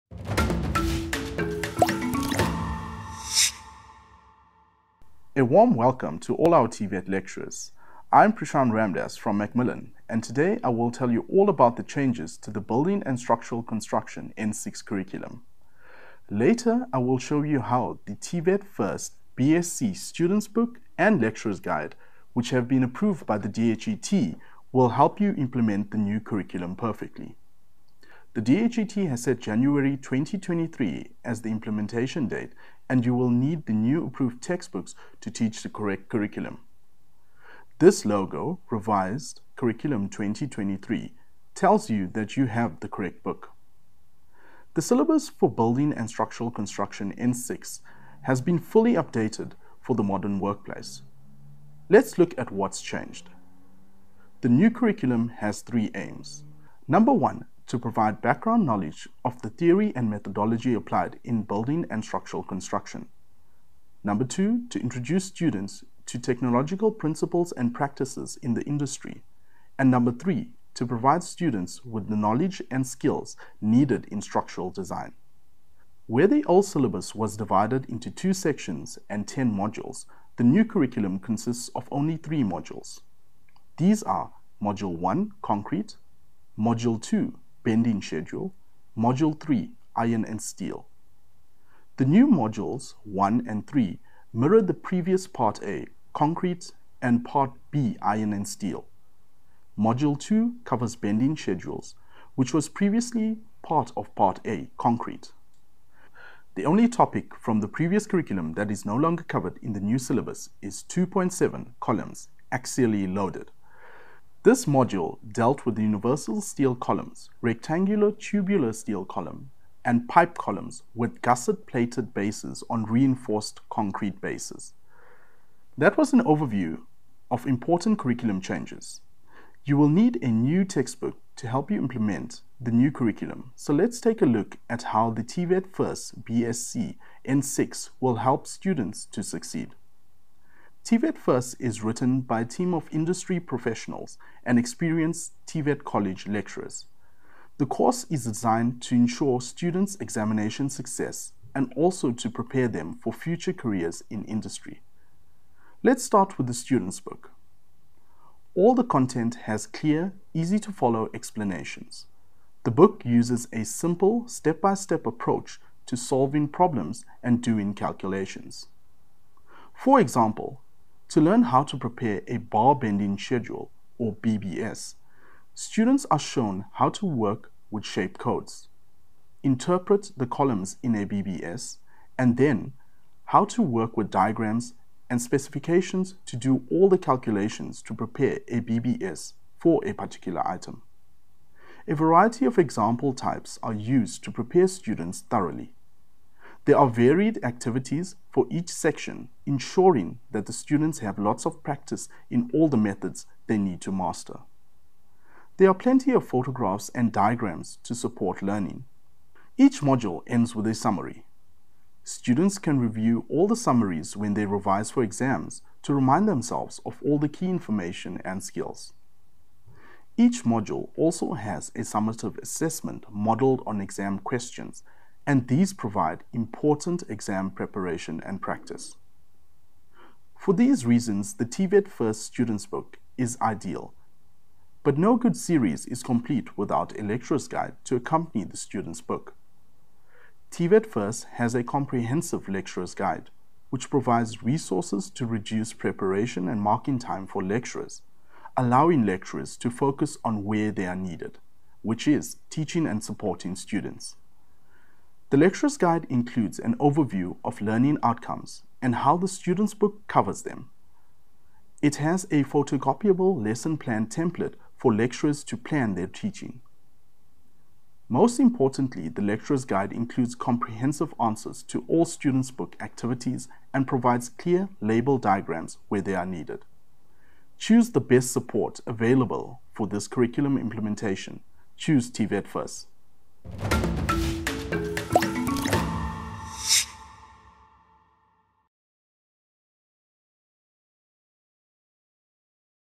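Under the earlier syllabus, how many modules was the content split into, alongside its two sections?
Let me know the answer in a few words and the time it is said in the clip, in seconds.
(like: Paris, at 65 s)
10, at 79 s.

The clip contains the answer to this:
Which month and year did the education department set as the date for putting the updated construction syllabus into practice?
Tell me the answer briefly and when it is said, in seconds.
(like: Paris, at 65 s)
January 2023, at 29 s.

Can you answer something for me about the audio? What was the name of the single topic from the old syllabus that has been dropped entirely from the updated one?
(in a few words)
columns, axially loaded.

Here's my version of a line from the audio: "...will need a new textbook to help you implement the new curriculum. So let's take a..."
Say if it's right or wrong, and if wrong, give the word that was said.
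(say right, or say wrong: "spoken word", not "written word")
right.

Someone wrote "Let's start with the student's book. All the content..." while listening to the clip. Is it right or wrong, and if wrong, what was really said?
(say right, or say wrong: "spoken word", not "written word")
right.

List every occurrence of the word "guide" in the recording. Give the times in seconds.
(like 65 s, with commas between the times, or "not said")
21 s, 237 s, 242 s, 255 s, 269 s.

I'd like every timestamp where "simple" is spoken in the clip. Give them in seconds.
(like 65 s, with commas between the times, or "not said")
163 s.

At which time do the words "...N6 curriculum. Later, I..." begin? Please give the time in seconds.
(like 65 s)
14 s.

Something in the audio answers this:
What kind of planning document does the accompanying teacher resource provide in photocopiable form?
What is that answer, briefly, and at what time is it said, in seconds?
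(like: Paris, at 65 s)
lesson plan template, at 263 s.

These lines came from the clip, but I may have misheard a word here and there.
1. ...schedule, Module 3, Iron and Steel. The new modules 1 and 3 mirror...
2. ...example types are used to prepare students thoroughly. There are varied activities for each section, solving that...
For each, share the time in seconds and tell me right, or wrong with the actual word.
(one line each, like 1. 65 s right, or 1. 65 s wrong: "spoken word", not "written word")
1. 88 s right
2. 192 s wrong: "ensuring", not "solving".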